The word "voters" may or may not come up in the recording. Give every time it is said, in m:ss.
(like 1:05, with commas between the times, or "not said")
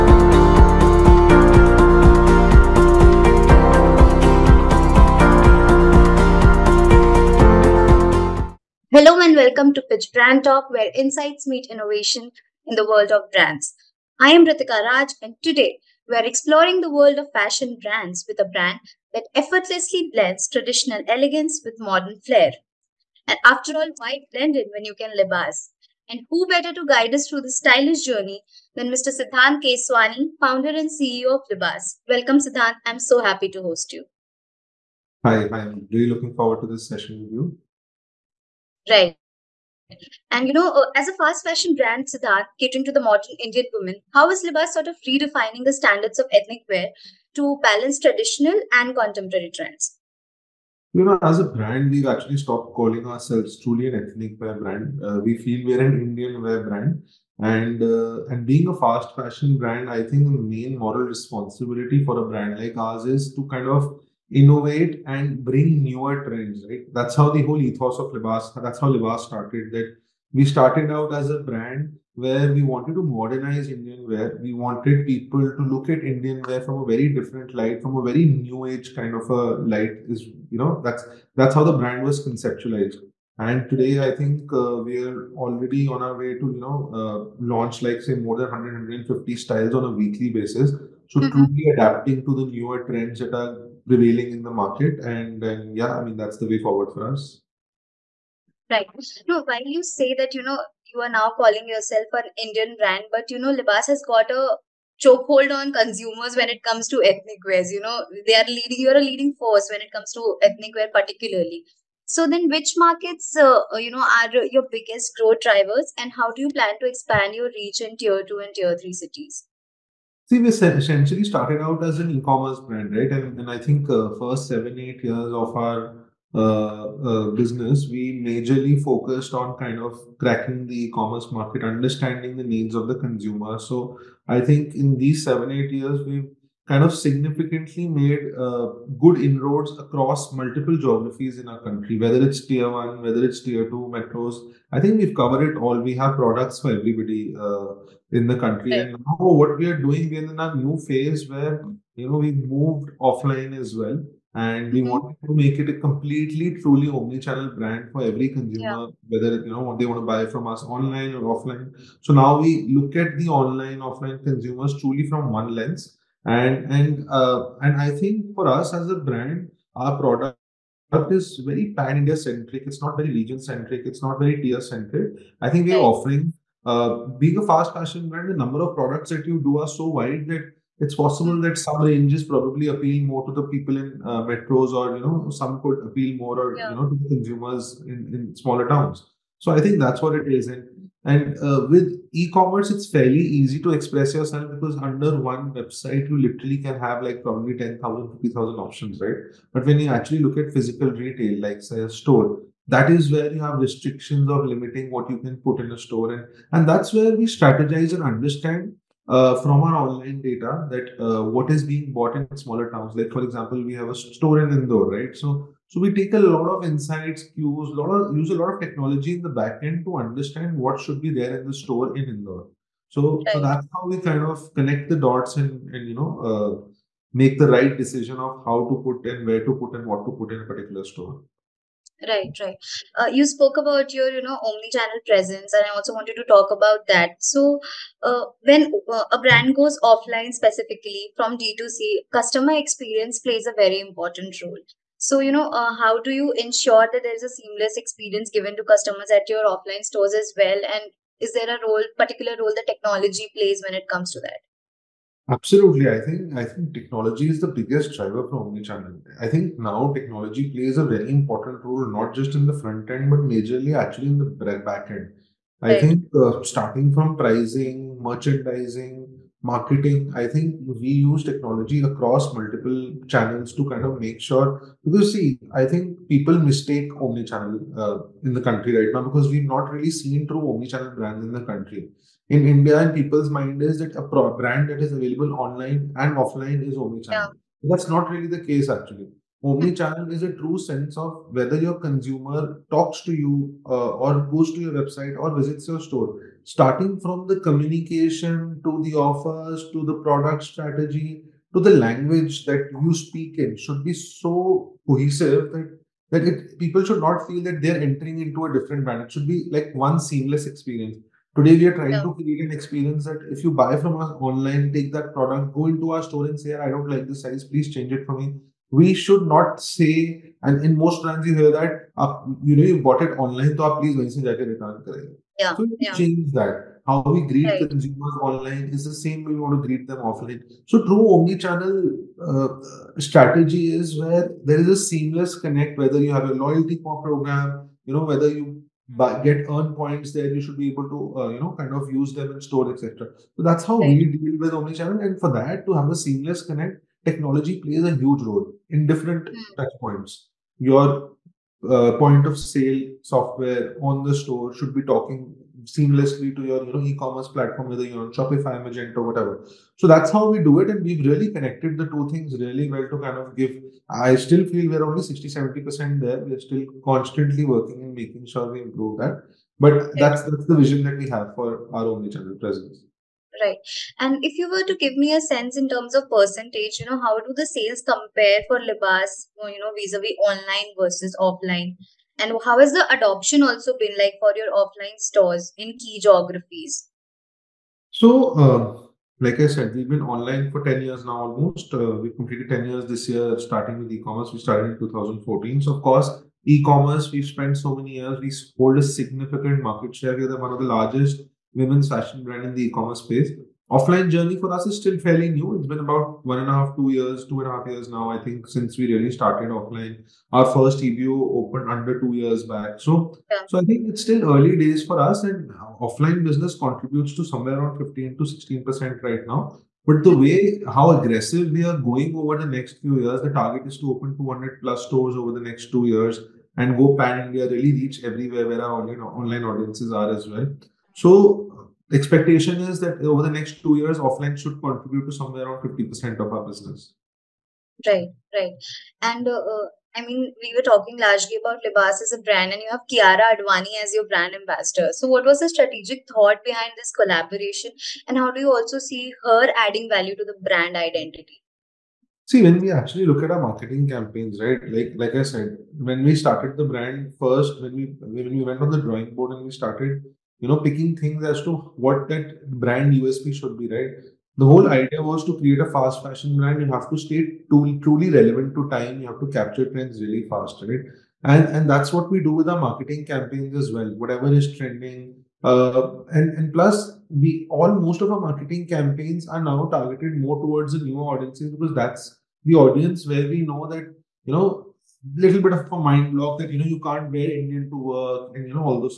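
not said.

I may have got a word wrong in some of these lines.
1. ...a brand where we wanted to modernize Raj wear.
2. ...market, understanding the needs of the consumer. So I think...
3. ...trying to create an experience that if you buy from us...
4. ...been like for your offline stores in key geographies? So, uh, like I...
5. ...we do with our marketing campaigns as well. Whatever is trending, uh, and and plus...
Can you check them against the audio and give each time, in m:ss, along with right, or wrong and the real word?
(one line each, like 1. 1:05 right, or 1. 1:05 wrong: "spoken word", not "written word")
1. 1:11 wrong: "Indian", not "Raj"
2. 2:11 right
3. 5:11 right
4. 6:23 right
5. 7:52 right.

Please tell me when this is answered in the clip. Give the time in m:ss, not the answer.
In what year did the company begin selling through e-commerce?
6:34.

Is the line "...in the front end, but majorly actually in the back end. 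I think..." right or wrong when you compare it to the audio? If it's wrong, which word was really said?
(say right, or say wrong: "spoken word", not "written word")
right.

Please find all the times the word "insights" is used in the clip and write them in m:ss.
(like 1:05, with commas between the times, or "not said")
0:10, 3:36.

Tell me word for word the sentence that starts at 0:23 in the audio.
And after all, why blend in when you can libas?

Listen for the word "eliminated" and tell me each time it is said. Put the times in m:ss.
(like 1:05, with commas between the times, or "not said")
not said.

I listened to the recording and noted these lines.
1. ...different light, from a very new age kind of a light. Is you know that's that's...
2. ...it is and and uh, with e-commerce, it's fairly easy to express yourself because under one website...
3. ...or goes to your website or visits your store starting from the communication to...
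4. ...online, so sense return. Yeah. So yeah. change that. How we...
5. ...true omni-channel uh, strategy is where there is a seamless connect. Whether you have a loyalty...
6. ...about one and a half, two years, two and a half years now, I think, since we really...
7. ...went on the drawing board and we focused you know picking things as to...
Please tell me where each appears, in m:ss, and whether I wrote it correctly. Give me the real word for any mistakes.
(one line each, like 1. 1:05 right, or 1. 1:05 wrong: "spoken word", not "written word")
1. 1:17 right
2. 3:10 right
3. 4:53 right
4. 5:23 wrong: "please", not "sense"
5. 5:30 right
6. 6:45 right
7. 7:38 wrong: "started", not "focused".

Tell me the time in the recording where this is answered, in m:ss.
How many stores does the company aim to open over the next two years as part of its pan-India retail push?
7:04.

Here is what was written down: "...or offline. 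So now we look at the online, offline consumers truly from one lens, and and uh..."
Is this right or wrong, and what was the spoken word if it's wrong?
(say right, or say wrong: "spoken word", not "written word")
right.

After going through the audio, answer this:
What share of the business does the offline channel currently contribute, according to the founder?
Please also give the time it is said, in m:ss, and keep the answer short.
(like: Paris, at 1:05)
15-16%, at 6:57.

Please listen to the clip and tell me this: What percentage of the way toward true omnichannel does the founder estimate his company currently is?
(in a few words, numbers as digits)
60-70%.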